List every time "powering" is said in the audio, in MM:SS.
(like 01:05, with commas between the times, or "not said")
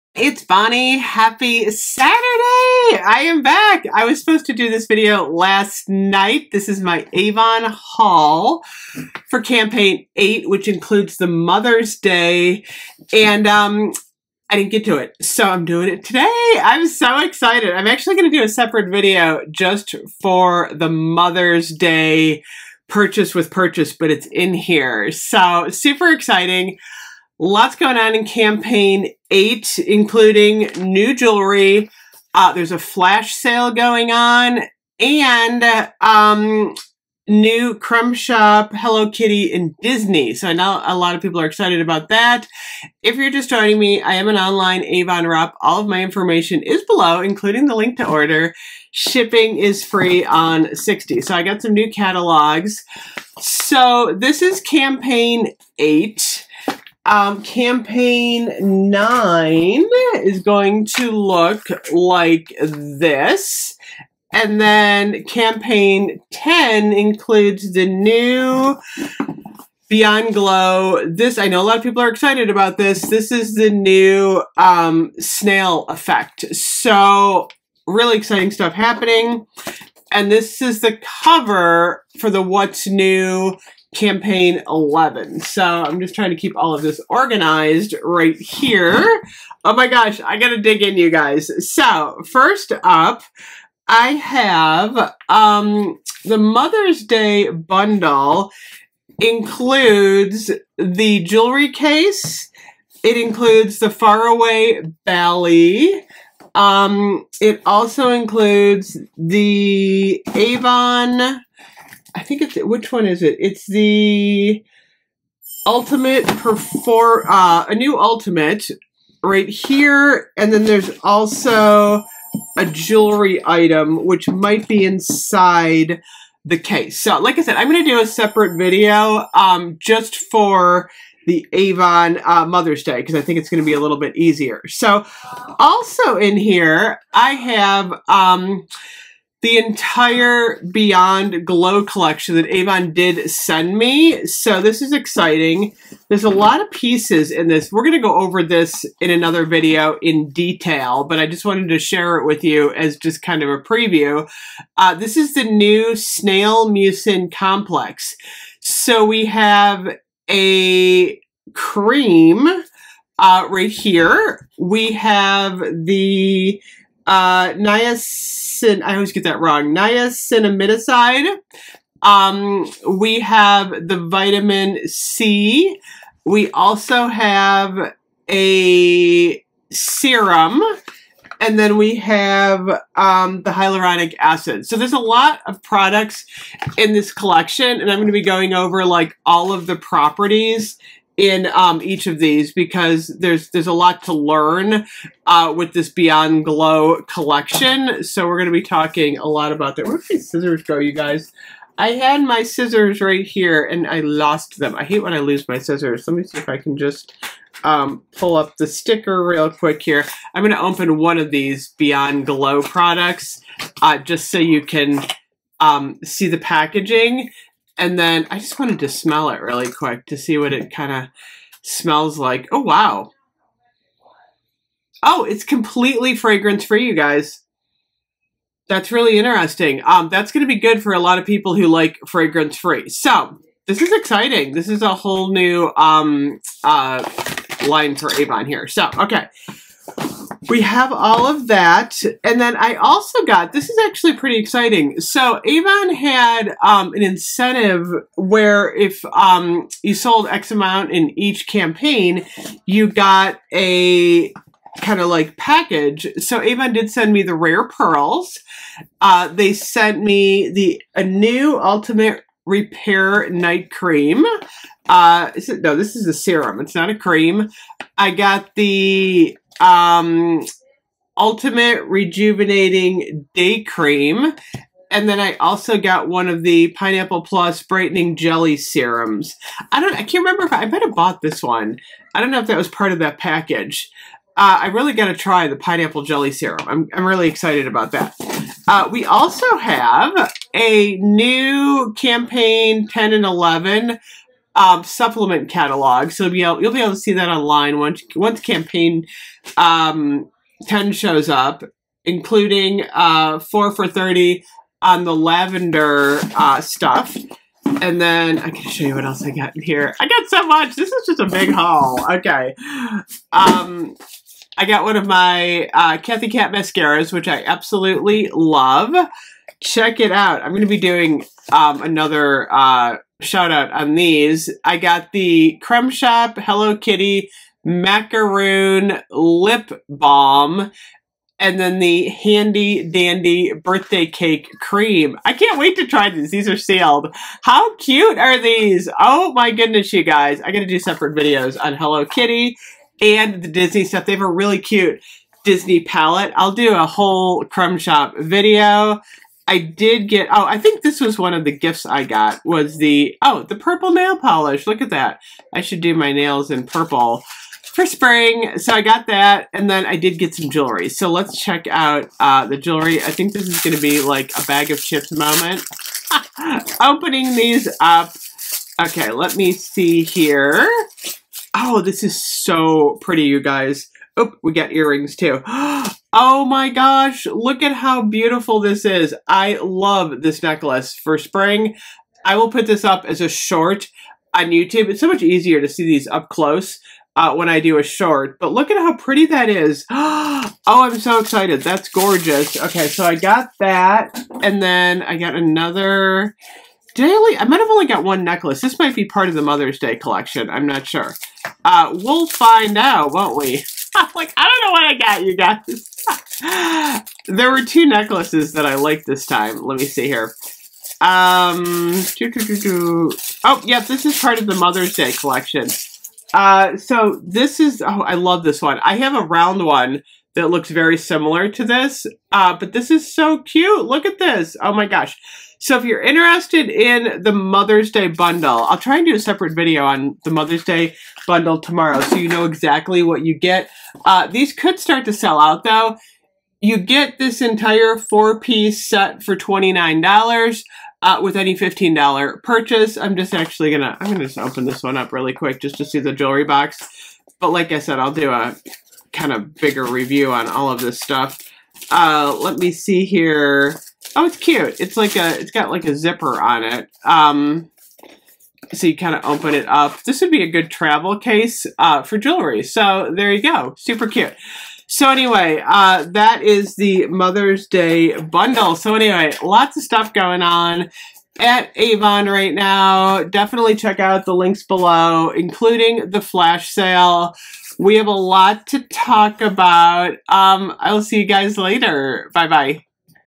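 not said.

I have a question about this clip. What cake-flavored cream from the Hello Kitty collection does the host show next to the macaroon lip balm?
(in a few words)
birthday cake cream.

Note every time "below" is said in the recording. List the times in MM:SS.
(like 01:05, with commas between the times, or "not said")
00:46, 07:54.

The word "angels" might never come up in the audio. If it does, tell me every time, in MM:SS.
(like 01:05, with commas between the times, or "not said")
not said.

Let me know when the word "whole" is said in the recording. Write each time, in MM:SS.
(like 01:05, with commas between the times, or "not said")
03:54, 05:46.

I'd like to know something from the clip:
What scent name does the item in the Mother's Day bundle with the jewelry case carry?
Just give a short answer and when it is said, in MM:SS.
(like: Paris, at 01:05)
Faraway Valley, at 01:43.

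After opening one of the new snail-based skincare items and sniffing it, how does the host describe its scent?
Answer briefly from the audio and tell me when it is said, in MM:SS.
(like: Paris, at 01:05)
Completely fragrance free, at 03:45.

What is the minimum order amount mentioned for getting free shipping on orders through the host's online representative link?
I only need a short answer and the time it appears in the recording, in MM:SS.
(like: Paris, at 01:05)
60, at 00:50.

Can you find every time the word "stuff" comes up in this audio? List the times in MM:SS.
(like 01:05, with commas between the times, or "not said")
01:18, 05:06, 05:43, 07:30, 07:49.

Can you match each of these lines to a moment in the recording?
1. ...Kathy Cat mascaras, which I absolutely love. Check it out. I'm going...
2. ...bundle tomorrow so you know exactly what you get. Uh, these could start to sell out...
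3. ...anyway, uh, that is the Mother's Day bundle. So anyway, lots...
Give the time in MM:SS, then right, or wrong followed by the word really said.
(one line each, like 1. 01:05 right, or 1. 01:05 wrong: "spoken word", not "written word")
1. 05:15 right
2. 07:11 right
3. 07:45 right.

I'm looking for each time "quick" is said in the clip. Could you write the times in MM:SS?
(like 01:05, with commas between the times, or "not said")
03:29, 03:39, 07:25.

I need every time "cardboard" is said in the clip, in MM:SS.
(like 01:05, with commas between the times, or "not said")
not said.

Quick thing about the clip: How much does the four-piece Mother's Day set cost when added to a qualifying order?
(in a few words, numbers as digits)
$29.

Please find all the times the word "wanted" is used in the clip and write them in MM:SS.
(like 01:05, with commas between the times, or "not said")
02:31, 03:38.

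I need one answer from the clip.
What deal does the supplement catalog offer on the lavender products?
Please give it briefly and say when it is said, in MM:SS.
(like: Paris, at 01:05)
4 for 30, at 05:03.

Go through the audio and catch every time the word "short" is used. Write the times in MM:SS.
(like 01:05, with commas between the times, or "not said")
06:23, 06:27.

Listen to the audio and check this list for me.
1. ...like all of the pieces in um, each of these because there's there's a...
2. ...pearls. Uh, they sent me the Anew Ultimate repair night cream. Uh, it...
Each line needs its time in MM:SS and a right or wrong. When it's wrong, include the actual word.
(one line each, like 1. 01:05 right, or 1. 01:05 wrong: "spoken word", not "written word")
1. 03:08 wrong: "properties", not "pieces"
2. 04:17 right.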